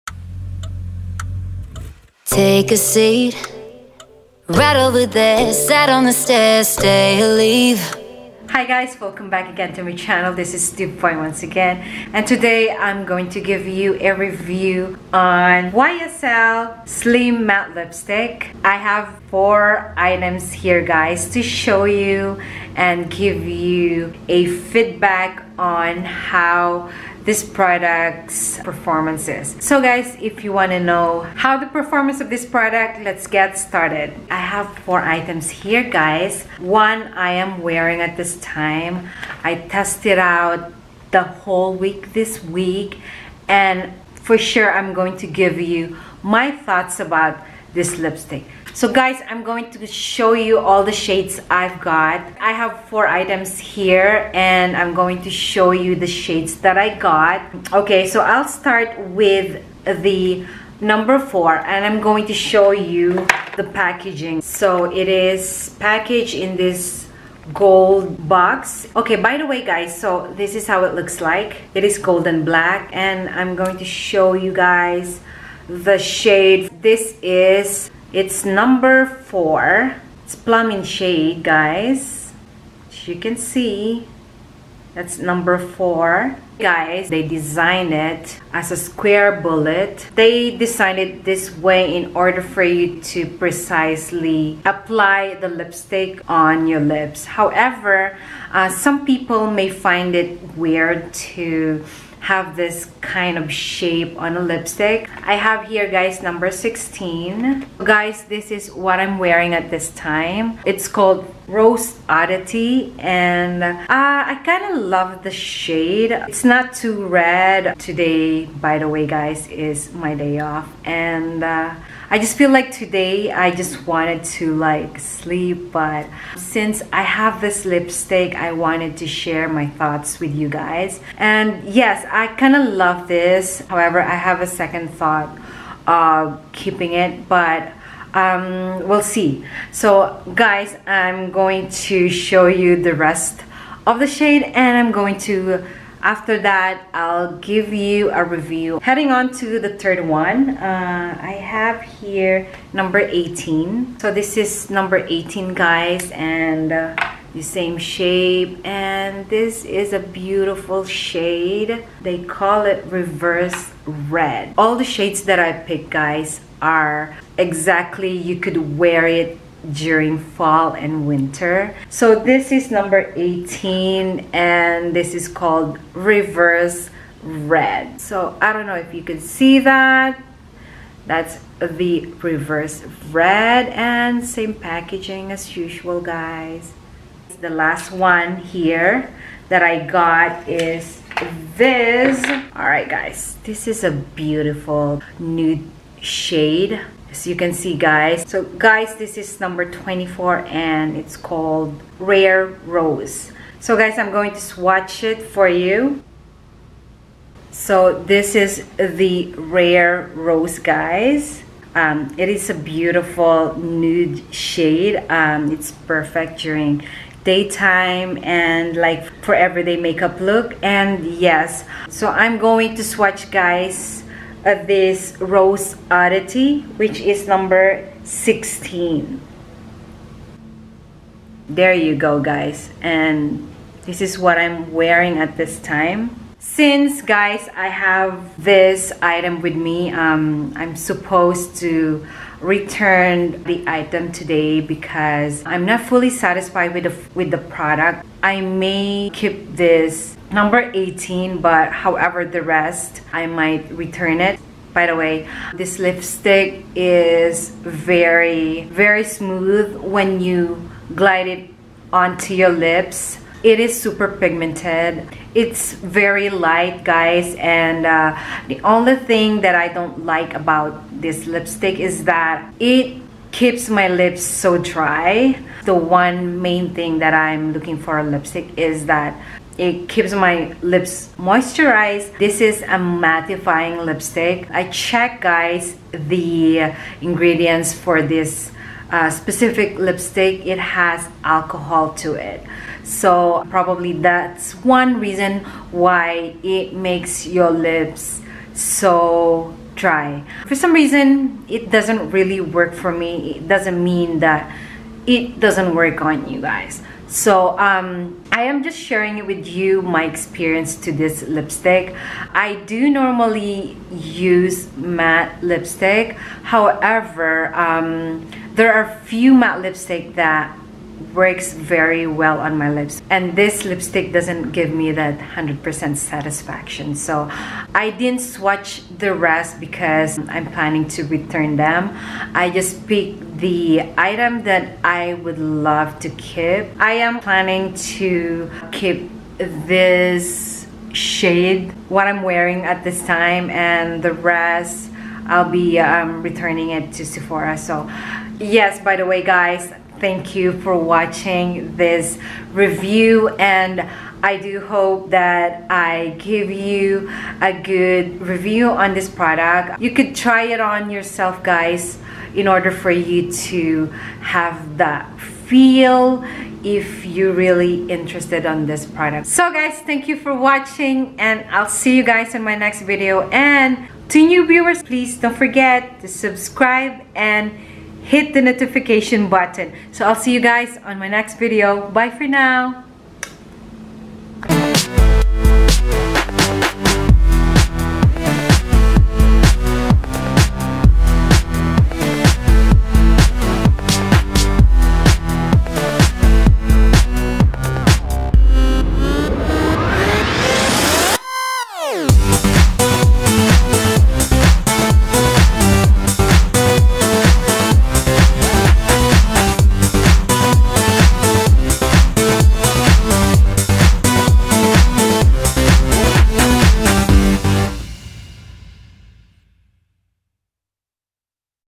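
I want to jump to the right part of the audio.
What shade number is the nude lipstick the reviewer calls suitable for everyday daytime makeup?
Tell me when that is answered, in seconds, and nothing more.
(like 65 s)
199 s.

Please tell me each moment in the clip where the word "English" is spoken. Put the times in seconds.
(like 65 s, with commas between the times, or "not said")
not said.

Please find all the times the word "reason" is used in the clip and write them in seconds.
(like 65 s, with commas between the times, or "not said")
294 s, 300 s.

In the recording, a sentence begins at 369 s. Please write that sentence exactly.
So guys, thank you for watching and I'll see you guys in my next video.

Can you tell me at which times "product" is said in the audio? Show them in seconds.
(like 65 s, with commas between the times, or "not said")
27 s, 32 s, 247 s, 359 s, 368 s.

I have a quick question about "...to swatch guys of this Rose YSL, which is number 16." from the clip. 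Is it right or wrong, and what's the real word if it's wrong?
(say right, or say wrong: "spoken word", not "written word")
wrong: "Oddity", not "YSL".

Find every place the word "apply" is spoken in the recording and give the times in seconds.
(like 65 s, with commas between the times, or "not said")
94 s.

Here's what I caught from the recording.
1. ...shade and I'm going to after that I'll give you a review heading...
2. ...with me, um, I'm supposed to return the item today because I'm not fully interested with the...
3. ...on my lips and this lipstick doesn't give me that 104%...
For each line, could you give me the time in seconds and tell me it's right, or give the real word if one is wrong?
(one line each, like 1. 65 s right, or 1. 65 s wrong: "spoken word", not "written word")
1. 144 s right
2. 239 s wrong: "satisfied", not "interested"
3. 322 s wrong: "100", not "104".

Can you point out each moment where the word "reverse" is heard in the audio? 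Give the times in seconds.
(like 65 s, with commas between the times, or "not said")
162 s, 175 s, 182 s.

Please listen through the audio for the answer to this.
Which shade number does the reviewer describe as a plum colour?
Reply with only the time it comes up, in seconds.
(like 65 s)
80 s.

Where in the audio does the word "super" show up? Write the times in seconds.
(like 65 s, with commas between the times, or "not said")
263 s.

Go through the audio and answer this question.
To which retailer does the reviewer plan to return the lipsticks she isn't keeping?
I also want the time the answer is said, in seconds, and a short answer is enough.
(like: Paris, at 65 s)
Sephora, at 347 s.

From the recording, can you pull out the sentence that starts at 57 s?
Okay, so I'll start with the number four and I'm going to show you the packaging.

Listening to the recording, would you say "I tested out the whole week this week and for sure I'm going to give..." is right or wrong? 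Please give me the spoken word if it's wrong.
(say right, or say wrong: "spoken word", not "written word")
right.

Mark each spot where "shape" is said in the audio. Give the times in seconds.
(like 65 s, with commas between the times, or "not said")
103 s, 157 s.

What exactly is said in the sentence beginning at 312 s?
I do normally use matte lipstick.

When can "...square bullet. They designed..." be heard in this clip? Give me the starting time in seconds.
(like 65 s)
88 s.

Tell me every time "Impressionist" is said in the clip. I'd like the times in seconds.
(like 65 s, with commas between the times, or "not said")
not said.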